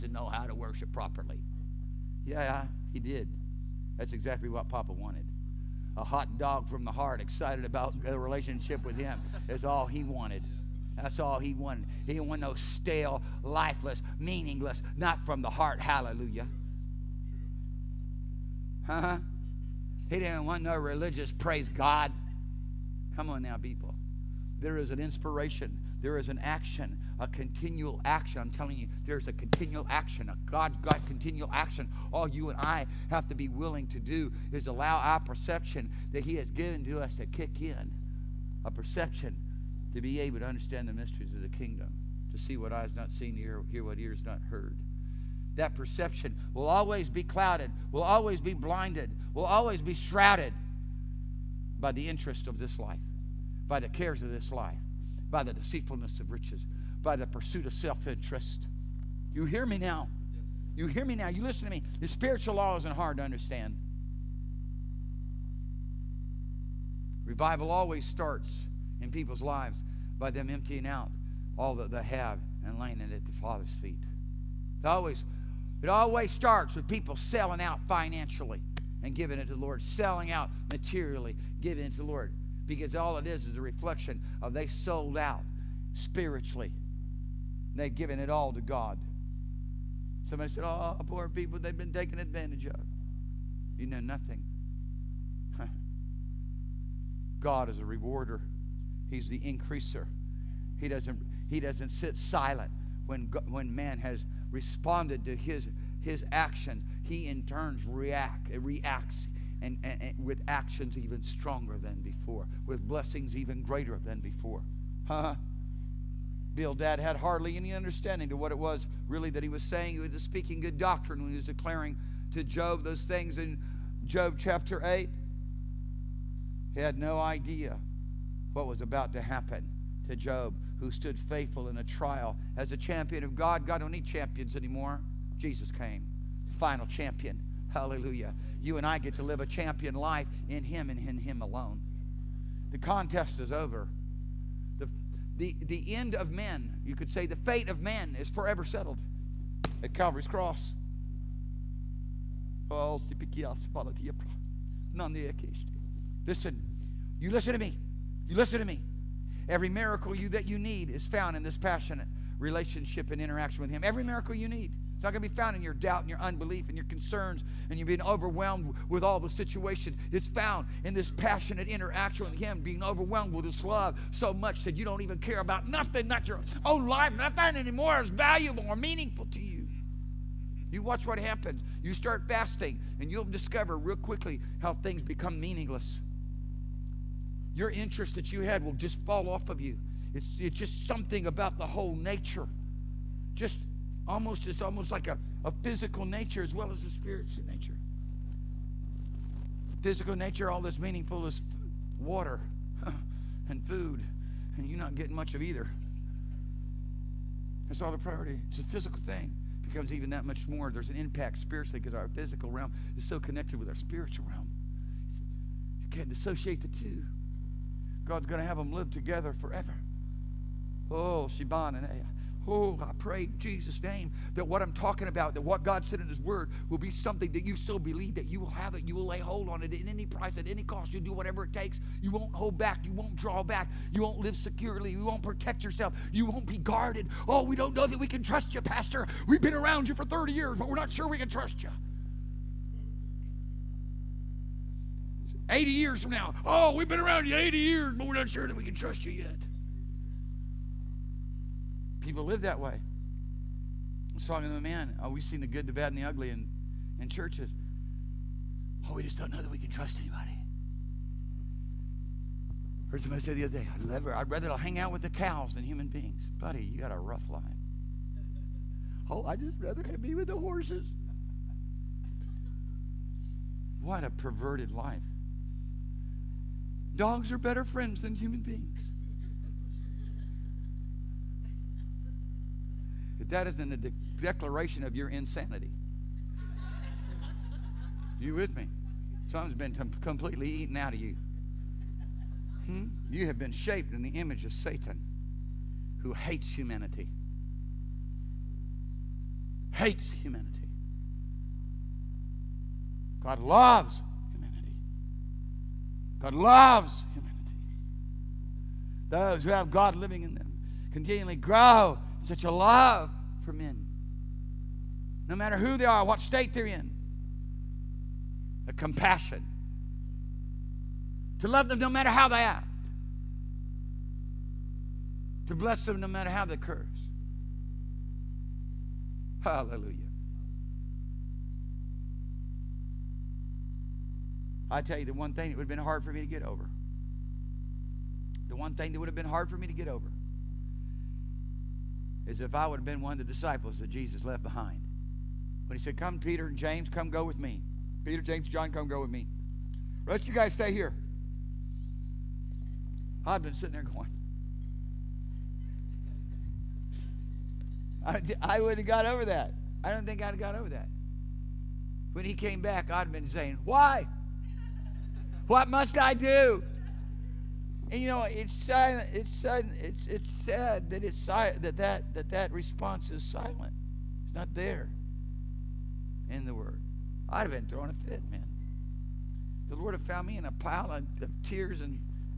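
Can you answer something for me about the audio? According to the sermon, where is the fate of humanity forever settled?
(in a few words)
Calvary's cross.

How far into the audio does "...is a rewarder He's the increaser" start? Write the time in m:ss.
1:37.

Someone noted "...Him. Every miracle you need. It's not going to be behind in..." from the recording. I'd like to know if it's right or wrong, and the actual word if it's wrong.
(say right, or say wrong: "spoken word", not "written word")
wrong: "found", not "behind".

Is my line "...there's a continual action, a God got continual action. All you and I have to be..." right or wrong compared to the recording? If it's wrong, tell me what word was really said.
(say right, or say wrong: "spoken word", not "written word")
right.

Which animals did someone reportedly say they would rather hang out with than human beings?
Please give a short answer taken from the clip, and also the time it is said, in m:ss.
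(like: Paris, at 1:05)
Cows, at 4:25.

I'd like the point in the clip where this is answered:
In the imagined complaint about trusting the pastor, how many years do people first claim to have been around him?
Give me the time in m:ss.
4:00.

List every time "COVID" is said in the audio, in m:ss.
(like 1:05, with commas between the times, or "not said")
not said.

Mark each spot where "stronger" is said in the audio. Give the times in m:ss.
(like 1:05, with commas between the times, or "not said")
1:51.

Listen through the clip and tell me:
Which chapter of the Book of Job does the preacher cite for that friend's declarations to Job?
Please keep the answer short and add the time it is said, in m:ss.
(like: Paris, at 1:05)
Job chapter 8, at 2:04.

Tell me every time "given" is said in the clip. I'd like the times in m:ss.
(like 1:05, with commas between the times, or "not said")
0:36, 1:27.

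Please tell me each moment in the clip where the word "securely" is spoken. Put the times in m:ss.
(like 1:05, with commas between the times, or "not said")
3:54.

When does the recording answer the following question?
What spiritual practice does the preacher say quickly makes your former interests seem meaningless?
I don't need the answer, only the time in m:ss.
3:02.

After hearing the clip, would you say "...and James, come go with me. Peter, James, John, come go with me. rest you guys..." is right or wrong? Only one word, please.
right.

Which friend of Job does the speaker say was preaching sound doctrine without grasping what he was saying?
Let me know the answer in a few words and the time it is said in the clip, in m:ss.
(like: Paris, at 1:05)
Bildad, at 1:56.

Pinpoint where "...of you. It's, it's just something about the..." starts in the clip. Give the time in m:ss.
3:09.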